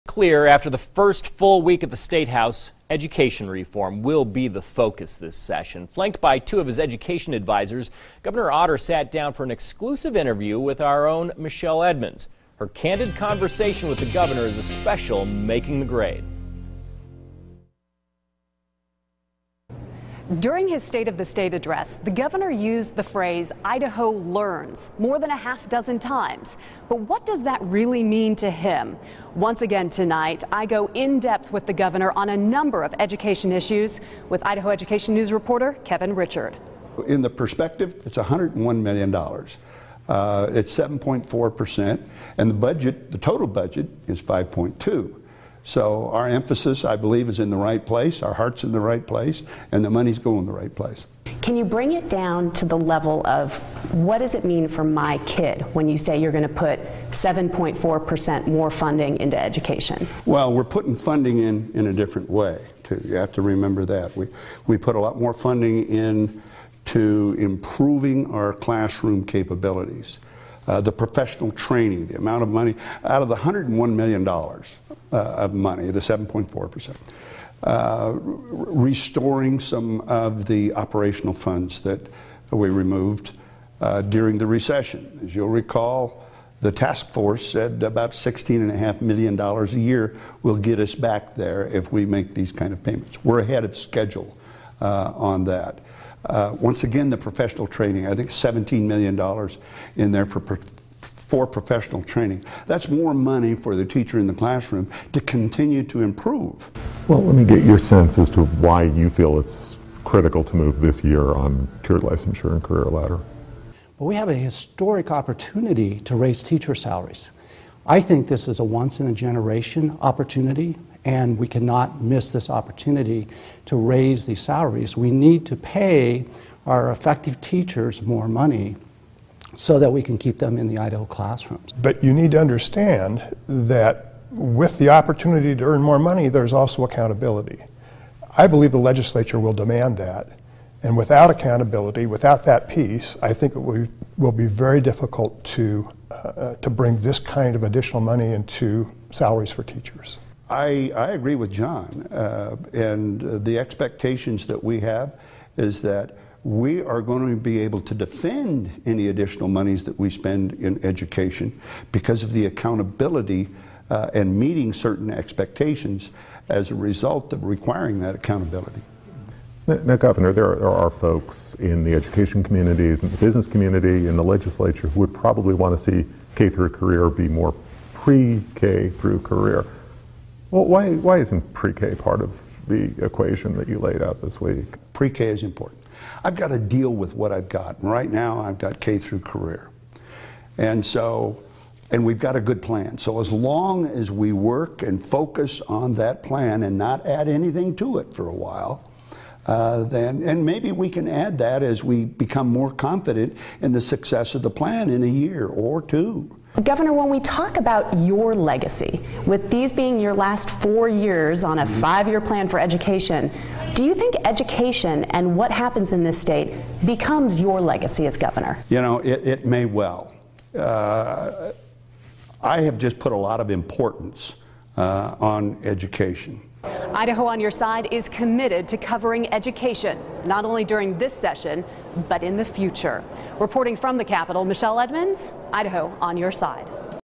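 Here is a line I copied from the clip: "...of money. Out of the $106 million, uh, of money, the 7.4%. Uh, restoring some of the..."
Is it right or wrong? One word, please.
wrong.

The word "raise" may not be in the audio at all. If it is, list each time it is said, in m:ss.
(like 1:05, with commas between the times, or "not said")
1:56, 2:03.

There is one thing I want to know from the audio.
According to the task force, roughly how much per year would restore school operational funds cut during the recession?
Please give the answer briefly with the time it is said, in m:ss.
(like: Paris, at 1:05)
$16.5 million, at 1:28.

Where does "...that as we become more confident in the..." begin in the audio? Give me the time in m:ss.
3:21.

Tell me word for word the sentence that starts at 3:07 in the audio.
And right now, I've got K through career.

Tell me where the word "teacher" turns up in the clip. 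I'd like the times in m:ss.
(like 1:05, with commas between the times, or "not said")
1:43, 1:56, 2:07, 2:29.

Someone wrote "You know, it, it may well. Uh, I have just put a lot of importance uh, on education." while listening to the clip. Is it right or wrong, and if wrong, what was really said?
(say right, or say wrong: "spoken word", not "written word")
right.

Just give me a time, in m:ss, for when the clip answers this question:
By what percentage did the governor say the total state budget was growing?
0:44.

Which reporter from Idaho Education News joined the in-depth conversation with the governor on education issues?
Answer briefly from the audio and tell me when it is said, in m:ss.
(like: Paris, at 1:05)
Kevin Richert, at 0:35.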